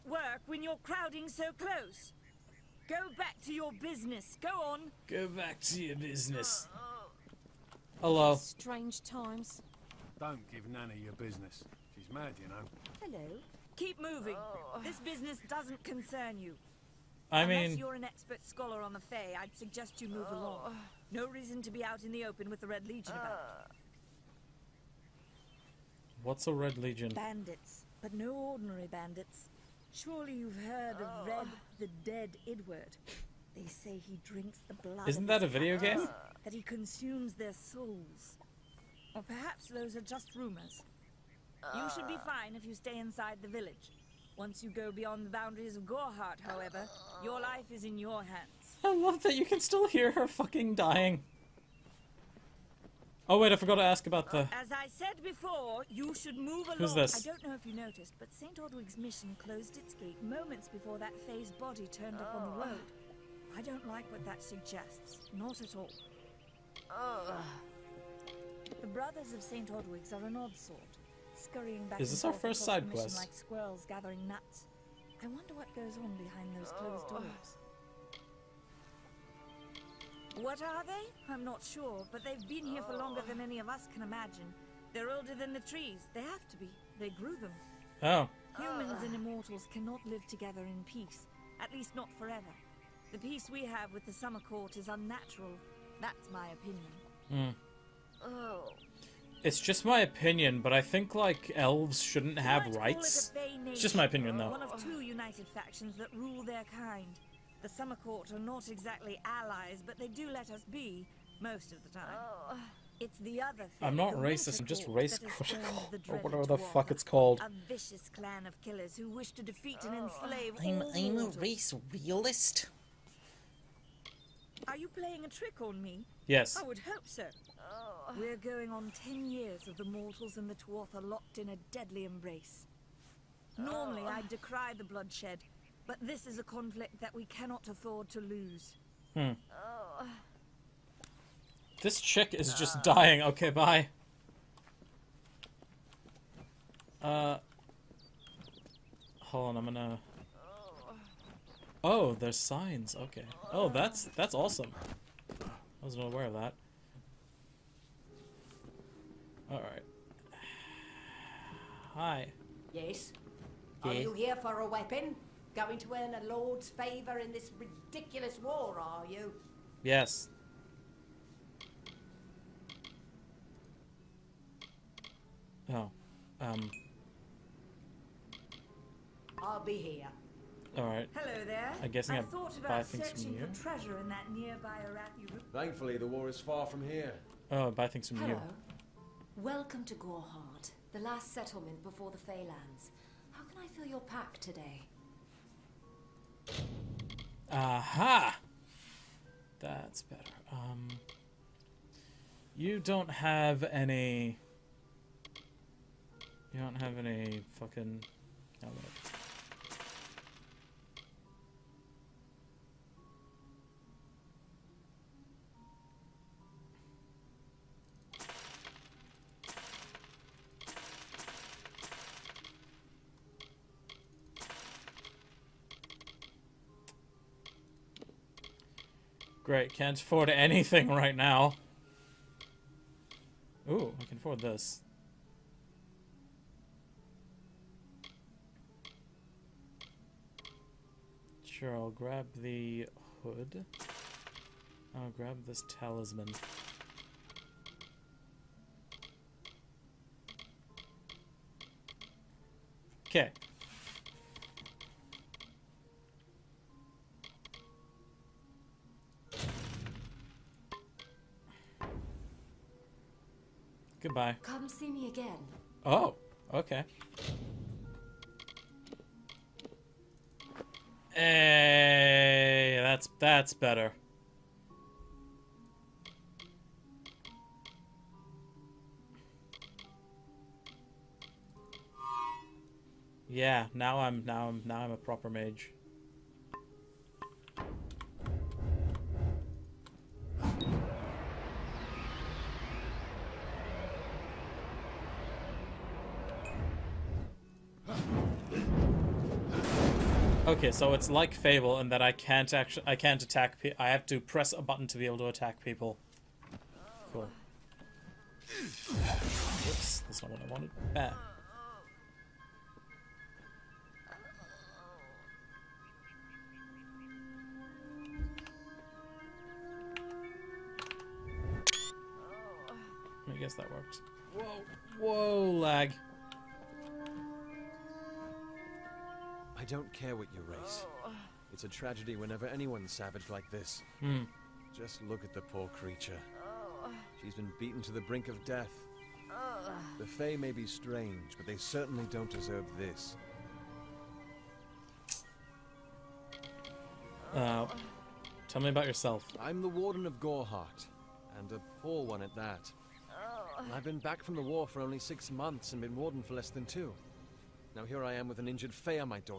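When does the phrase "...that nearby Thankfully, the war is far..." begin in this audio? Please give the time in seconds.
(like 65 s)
184 s.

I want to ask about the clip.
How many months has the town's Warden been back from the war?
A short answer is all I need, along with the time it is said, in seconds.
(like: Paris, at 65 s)
6 months, at 354 s.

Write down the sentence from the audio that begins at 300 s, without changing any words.
Okay, so it's like Fable in that I can't actually I can't attack.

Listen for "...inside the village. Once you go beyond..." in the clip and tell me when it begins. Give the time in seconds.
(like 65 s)
42 s.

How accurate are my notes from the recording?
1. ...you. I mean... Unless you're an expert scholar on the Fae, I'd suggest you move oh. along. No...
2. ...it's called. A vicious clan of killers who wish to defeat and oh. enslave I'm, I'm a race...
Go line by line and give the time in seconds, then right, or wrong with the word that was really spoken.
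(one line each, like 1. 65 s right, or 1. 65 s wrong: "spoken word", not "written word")
1. 16 s right
2. 116 s right.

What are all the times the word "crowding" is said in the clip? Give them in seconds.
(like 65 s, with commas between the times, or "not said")
0 s.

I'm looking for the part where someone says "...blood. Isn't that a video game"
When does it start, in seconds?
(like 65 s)
34 s.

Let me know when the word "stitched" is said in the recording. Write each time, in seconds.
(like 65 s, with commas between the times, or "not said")
not said.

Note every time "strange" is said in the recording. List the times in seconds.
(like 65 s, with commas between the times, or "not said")
8 s, 340 s.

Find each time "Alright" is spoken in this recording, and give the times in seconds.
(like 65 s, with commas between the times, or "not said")
180 s.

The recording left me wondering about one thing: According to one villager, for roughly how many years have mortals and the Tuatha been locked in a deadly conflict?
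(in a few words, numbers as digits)
10 years.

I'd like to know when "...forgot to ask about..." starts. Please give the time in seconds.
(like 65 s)
53 s.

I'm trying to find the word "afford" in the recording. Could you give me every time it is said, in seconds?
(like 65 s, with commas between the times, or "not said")
137 s, 229 s, 234 s.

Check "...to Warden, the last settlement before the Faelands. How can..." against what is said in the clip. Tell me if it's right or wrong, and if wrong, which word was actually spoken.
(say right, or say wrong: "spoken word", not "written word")
wrong: "Gorhart", not "Warden".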